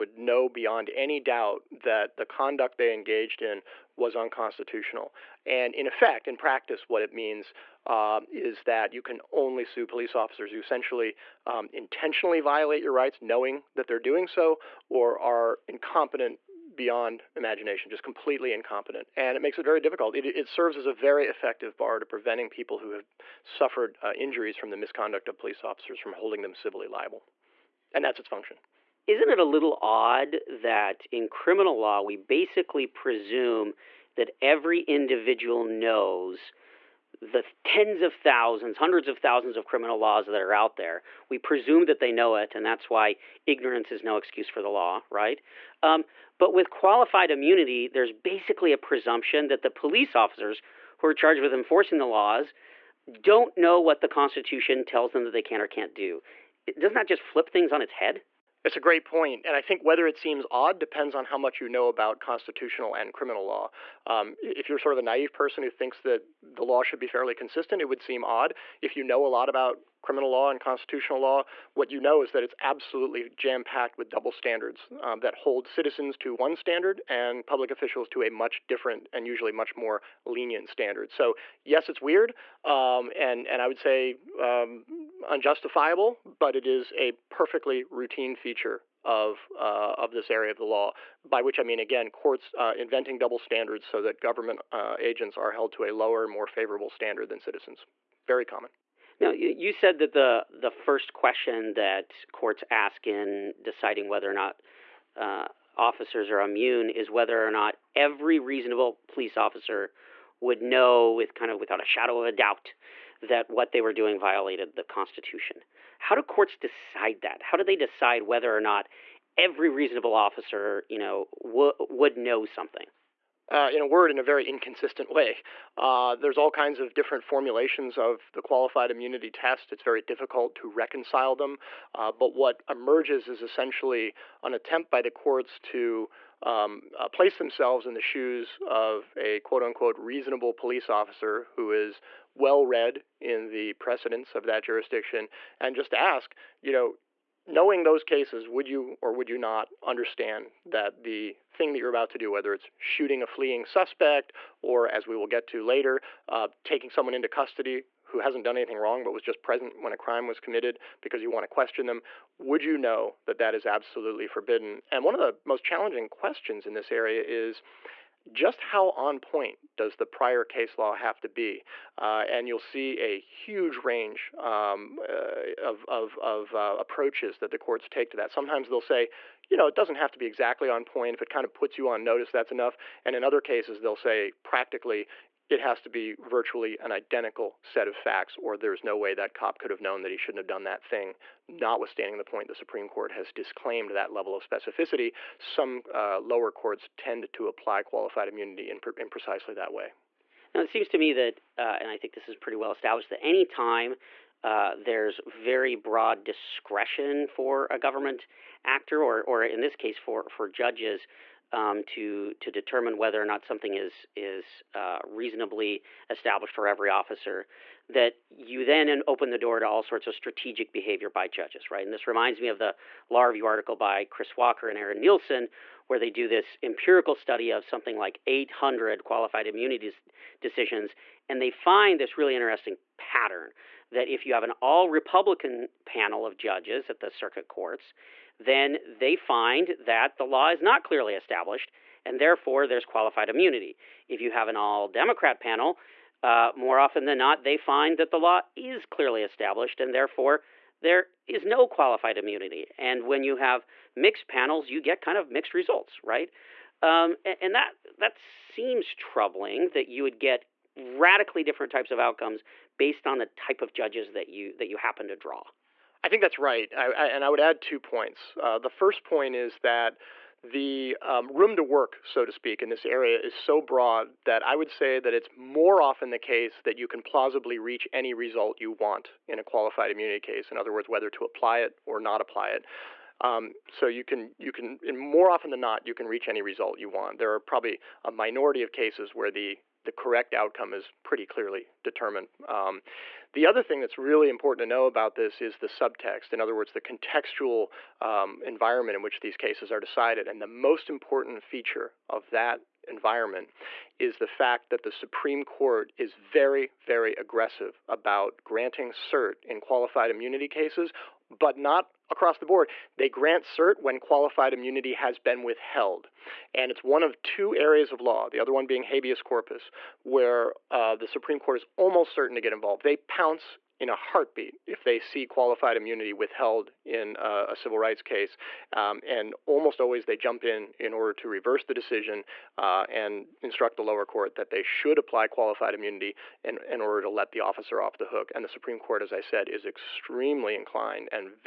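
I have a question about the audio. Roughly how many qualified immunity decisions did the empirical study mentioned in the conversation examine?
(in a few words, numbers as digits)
800.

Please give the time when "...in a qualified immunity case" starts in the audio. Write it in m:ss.
4:39.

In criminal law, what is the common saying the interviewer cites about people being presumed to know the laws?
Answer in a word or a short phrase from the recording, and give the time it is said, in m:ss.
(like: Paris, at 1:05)
ignorance is no excuse, at 0:43.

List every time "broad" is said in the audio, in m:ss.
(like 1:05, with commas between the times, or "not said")
3:25, 4:33.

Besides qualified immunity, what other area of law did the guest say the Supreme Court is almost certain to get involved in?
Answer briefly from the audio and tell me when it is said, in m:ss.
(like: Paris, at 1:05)
habeas corpus, at 5:18.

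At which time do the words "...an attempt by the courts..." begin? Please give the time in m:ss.
2:14.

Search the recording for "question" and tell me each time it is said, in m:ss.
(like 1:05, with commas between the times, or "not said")
1:41, 2:41, 2:46.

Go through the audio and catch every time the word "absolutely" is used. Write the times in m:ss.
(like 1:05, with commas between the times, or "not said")
1:12, 2:43.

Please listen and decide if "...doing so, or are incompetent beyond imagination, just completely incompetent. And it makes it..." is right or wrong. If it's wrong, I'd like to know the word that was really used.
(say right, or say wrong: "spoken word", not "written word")
right.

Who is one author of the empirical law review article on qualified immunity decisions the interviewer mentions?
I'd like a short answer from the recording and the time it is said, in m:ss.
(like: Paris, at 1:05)
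Chris Walker, at 3:44.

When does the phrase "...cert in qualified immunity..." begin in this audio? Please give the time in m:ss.
5:08.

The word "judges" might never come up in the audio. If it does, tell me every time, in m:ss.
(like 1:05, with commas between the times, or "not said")
3:30, 3:41, 3:56, 4:23.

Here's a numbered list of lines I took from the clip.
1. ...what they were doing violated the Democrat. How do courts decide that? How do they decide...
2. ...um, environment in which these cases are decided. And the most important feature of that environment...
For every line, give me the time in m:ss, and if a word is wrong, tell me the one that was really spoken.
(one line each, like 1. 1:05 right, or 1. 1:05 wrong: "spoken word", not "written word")
1. 1:53 wrong: "Constitution", not "Democrat"
2. 4:58 right.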